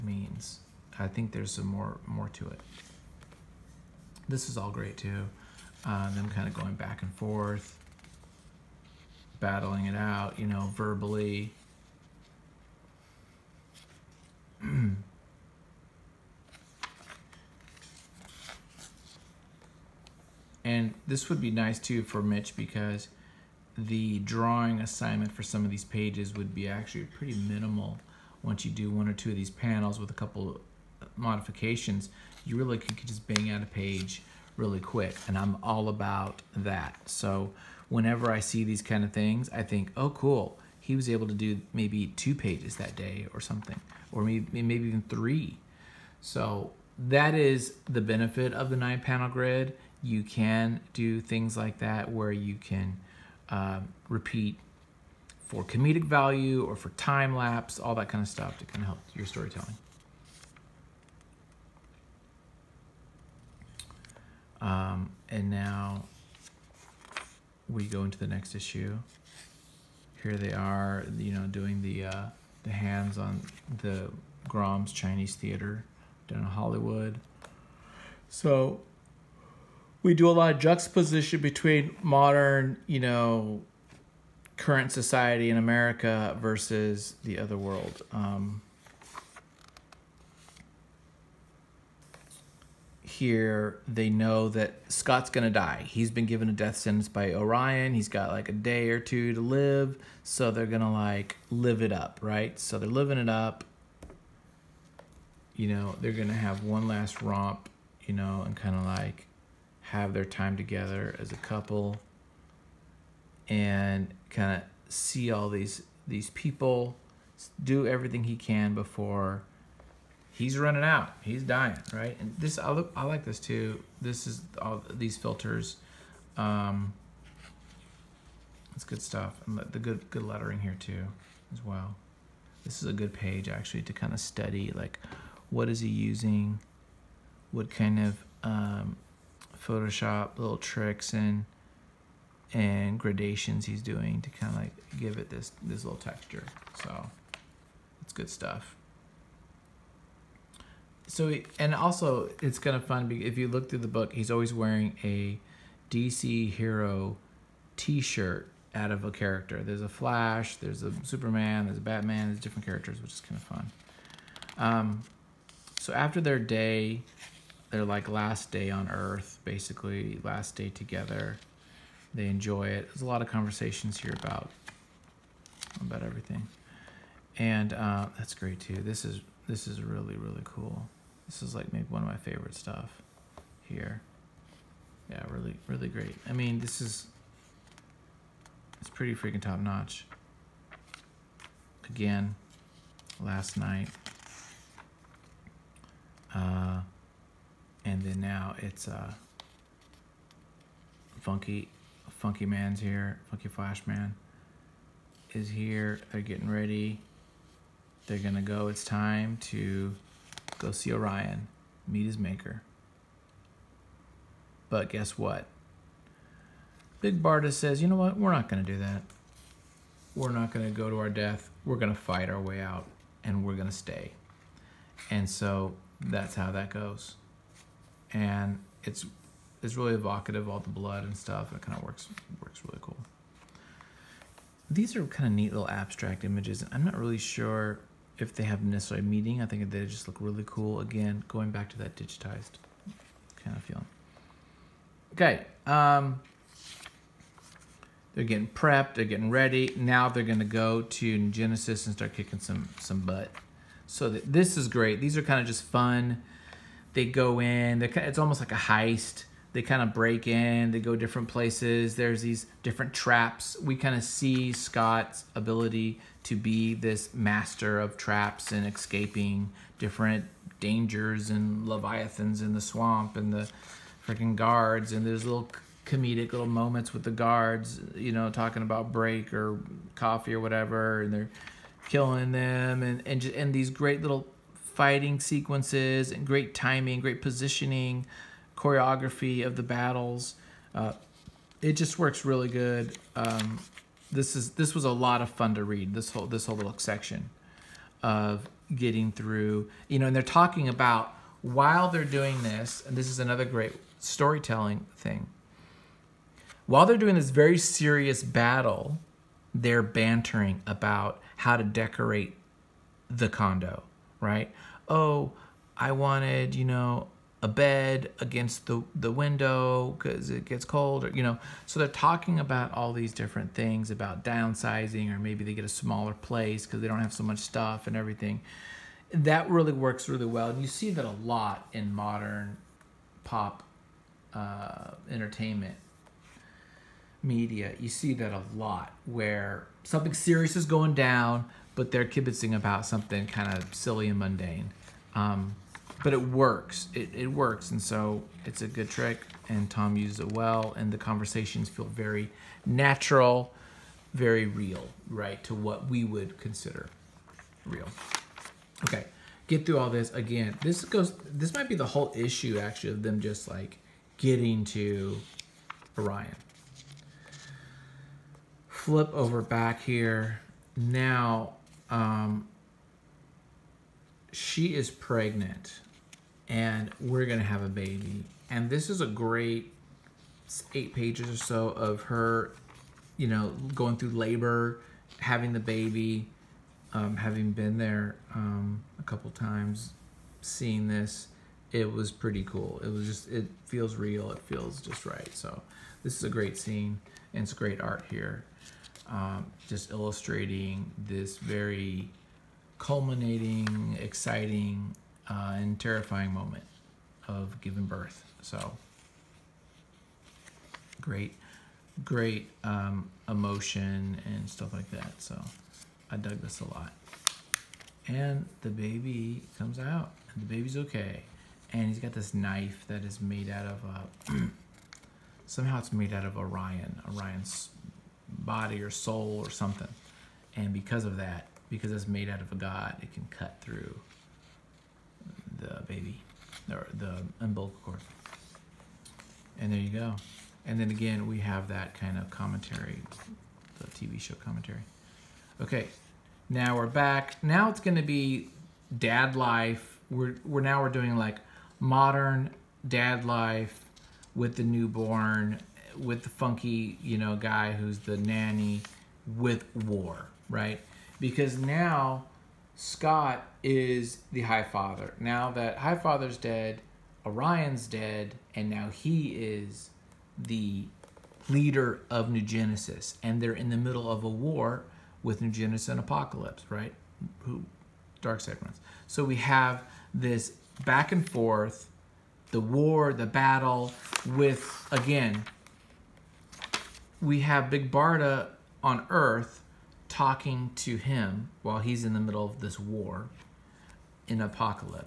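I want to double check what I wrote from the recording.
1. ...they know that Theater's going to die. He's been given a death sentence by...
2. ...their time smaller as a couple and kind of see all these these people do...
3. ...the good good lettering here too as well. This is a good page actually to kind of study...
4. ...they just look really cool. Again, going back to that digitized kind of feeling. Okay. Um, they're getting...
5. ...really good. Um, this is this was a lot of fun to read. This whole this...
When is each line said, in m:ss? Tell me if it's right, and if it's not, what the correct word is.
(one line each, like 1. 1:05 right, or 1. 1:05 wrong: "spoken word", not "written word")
1. 1:33 wrong: "Scott", not "Theater"
2. 1:50 wrong: "together", not "smaller"
3. 2:09 right
4. 3:59 right
5. 4:52 right.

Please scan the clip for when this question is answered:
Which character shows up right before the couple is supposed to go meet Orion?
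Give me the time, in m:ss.
3:23.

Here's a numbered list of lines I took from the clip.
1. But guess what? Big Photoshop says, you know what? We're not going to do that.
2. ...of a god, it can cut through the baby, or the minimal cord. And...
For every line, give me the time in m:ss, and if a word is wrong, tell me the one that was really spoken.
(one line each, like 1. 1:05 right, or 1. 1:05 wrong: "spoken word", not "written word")
1. 3:34 wrong: "Barda", not "Photoshop"
2. 7:12 wrong: "umbilical", not "minimal".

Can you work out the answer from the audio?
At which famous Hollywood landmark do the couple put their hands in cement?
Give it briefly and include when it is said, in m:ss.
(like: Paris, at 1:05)
Grauman's Chinese Theater, at 1:14.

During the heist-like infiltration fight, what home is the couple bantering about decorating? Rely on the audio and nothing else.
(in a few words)
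the condo.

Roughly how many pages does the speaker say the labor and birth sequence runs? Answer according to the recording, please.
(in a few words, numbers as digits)
8.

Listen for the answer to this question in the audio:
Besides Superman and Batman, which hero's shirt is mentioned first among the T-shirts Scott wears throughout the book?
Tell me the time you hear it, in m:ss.
2:39.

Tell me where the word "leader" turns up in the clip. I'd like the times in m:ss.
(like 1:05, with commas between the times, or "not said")
7:51.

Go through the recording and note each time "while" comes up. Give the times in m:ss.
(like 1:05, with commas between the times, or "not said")
5:01, 5:06, 8:11.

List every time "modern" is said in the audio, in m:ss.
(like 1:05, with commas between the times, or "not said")
1:22, 5:31, 7:31.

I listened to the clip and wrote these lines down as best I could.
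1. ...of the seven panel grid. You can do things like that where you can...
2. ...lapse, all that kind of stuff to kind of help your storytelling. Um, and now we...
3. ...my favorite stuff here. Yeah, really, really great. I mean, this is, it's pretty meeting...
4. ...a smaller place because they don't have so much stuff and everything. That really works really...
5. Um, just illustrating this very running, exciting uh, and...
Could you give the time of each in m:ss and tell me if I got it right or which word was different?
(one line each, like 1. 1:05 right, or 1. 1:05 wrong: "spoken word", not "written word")
1. 0:48 wrong: "nine", not "seven"
2. 0:57 right
3. 3:02 wrong: "freaking", not "meeting"
4. 5:25 right
5. 6:39 wrong: "culminating", not "running".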